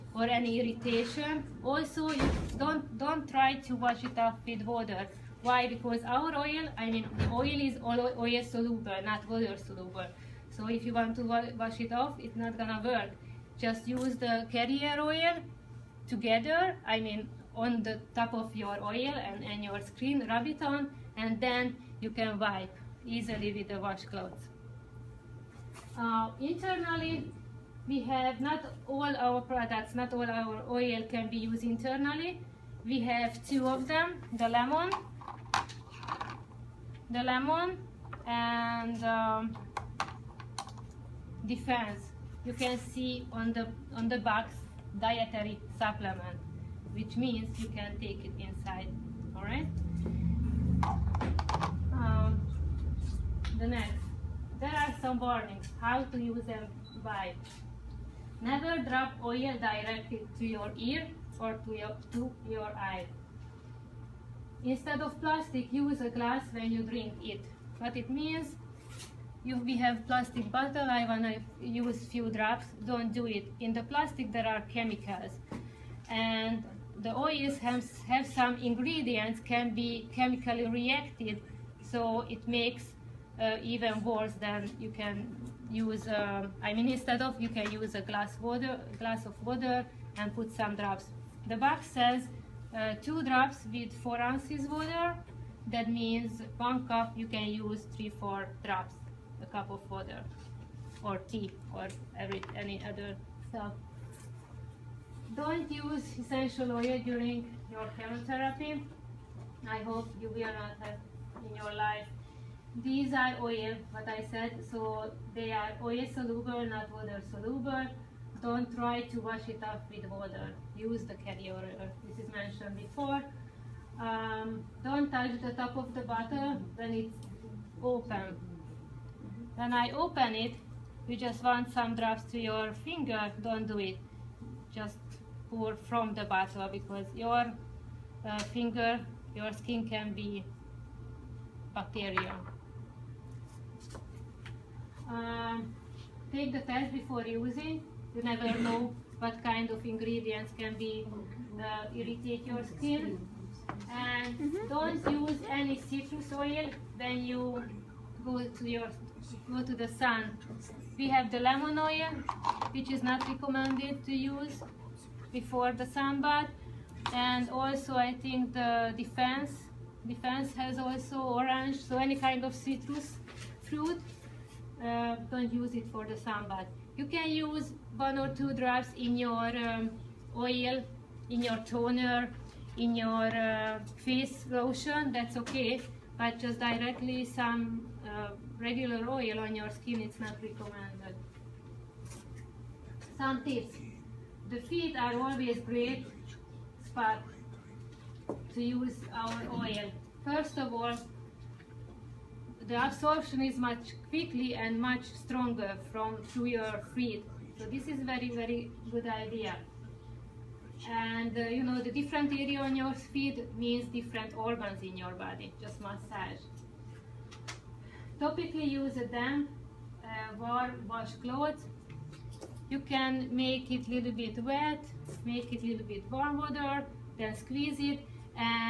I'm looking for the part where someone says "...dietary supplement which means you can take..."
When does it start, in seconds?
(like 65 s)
44 s.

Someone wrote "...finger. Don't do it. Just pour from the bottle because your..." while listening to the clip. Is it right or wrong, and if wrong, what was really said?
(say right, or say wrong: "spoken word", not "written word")
right.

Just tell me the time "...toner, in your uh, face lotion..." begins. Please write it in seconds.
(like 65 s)
181 s.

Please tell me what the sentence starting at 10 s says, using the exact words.
So if you want to wash it off, it's not gonna work.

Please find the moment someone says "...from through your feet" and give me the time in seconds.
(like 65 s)
205 s.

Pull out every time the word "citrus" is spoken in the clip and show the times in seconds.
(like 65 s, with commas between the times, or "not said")
155 s, 172 s.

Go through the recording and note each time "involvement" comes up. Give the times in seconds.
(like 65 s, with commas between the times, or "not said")
not said.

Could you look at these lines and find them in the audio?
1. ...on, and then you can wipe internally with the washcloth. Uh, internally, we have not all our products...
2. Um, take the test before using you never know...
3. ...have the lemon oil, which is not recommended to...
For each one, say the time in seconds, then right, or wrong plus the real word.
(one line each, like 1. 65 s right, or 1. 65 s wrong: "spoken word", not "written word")
1. 20 s wrong: "easily", not "internally"
2. 145 s right
3. 161 s right.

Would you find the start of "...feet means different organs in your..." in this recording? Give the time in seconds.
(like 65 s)
212 s.